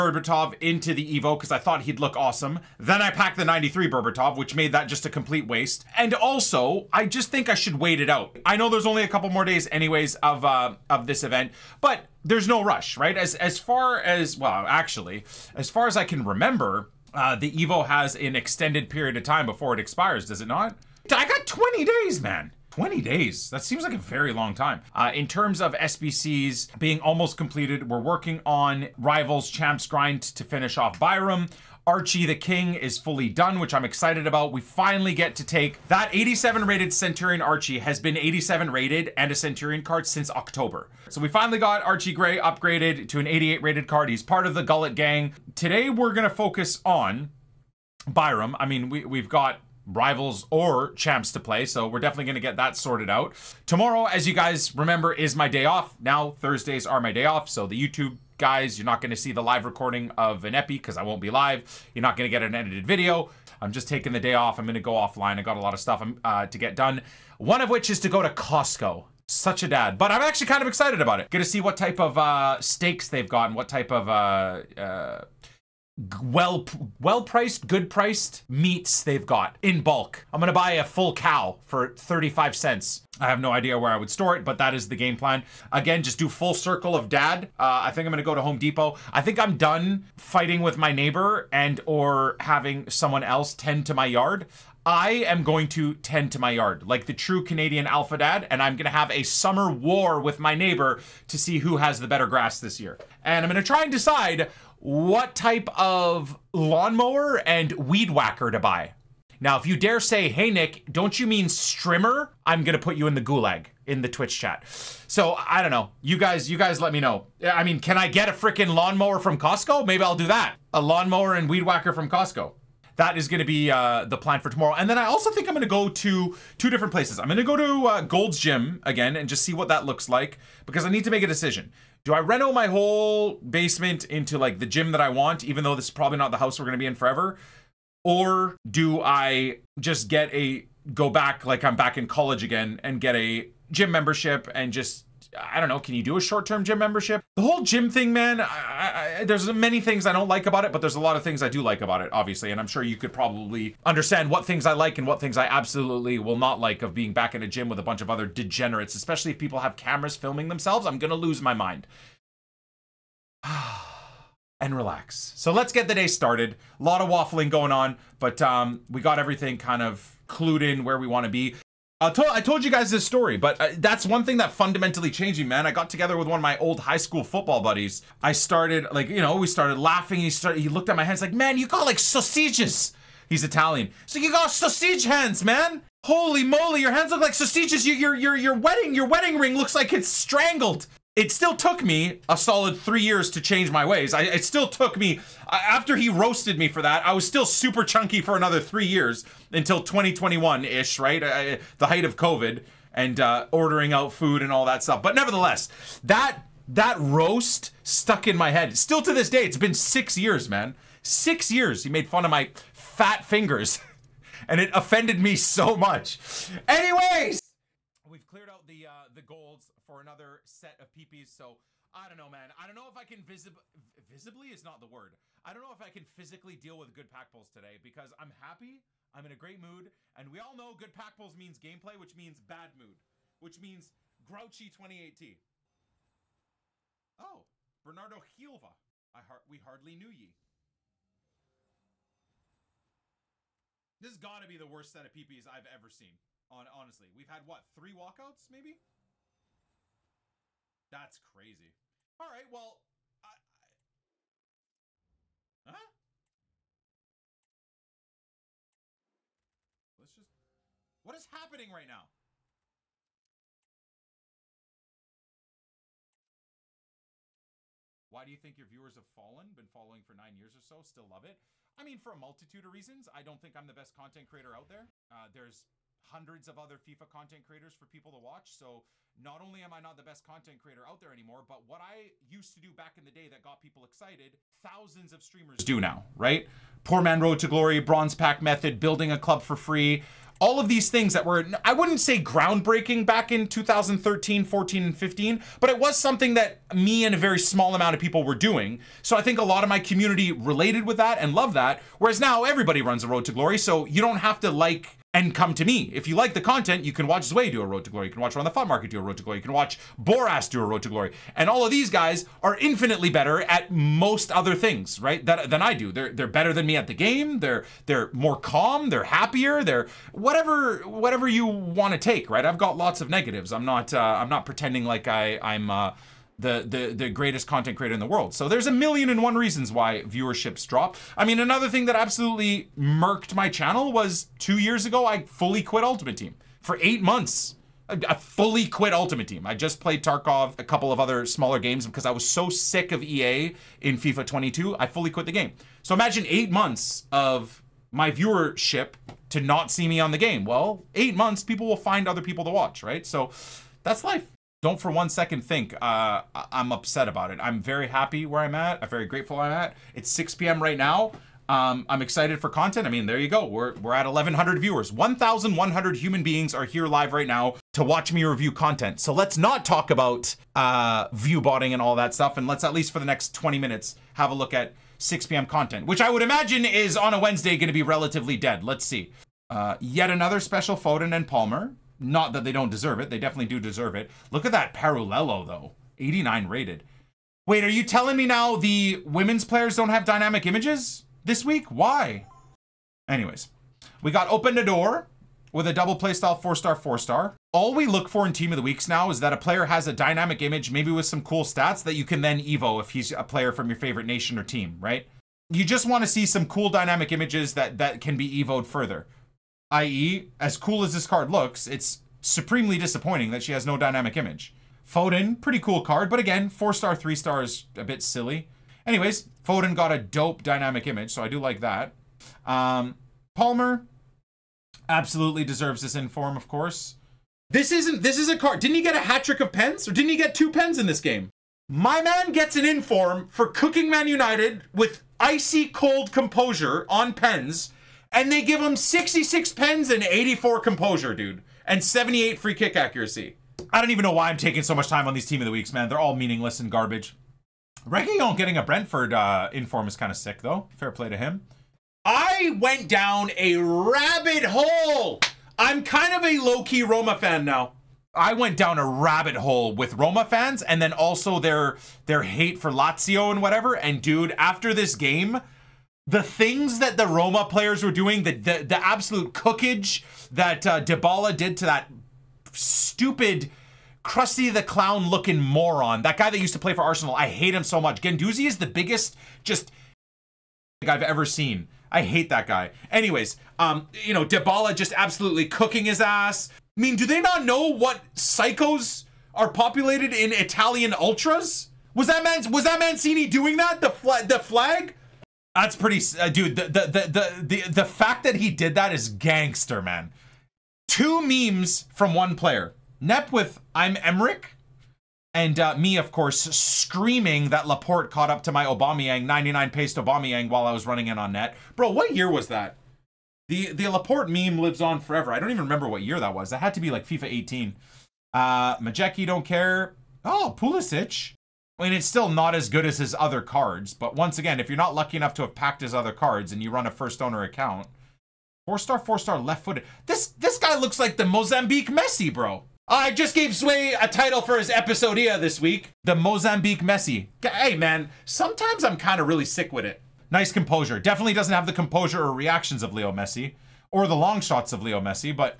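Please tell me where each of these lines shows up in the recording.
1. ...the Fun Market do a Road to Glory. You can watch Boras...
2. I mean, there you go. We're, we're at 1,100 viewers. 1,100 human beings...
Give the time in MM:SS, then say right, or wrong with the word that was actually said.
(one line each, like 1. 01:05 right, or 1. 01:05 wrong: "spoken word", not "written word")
1. 05:08 right
2. 06:02 right.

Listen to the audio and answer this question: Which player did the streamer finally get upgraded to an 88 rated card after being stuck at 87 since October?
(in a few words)
Archie Gray.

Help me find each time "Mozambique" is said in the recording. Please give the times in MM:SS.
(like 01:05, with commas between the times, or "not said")
08:51, 08:56.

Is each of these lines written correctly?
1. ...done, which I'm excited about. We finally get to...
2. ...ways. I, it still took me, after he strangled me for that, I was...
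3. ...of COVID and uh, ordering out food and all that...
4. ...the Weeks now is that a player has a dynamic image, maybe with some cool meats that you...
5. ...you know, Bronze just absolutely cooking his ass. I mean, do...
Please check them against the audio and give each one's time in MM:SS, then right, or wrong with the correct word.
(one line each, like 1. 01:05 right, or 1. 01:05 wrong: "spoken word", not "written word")
1. 00:33 right
2. 03:13 wrong: "roasted", not "strangled"
3. 03:22 right
4. 06:38 wrong: "stats", not "meats"
5. 08:04 wrong: "Dybala", not "Bronze".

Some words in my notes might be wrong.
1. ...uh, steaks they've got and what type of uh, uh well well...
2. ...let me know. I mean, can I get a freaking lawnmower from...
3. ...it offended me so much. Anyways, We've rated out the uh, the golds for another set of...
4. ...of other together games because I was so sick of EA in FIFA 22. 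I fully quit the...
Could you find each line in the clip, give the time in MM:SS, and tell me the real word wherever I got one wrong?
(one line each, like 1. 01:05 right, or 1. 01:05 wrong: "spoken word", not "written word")
1. 01:12 right
2. 01:56 right
3. 03:34 wrong: "cleared", not "rated"
4. 05:40 wrong: "smaller", not "together".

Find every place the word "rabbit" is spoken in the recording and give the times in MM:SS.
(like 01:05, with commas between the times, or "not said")
07:33, 07:38.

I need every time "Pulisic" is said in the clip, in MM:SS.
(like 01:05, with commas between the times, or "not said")
08:40.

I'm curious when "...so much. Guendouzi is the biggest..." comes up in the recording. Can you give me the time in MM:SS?
07:57.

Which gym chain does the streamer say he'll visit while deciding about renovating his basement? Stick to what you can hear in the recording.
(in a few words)
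Gold's Gym.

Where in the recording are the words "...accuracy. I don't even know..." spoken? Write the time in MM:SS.
07:22.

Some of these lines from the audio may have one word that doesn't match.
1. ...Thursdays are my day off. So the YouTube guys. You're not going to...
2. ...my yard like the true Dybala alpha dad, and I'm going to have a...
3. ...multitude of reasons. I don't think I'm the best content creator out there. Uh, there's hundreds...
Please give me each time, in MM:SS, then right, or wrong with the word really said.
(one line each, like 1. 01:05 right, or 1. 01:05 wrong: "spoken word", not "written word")
1. 00:56 right
2. 01:36 wrong: "Canadian", not "Dybala"
3. 04:32 right.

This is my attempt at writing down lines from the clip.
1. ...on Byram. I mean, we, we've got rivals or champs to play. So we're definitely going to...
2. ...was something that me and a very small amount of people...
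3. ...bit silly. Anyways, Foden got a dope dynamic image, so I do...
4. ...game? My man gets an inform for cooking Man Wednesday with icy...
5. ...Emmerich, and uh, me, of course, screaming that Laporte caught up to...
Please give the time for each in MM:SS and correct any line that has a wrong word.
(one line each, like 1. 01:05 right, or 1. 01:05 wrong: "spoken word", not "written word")
1. 00:46 right
2. 04:55 right
3. 06:57 right
4. 07:11 wrong: "United", not "Wednesday"
5. 08:24 right.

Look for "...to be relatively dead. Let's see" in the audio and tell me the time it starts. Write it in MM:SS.
06:17.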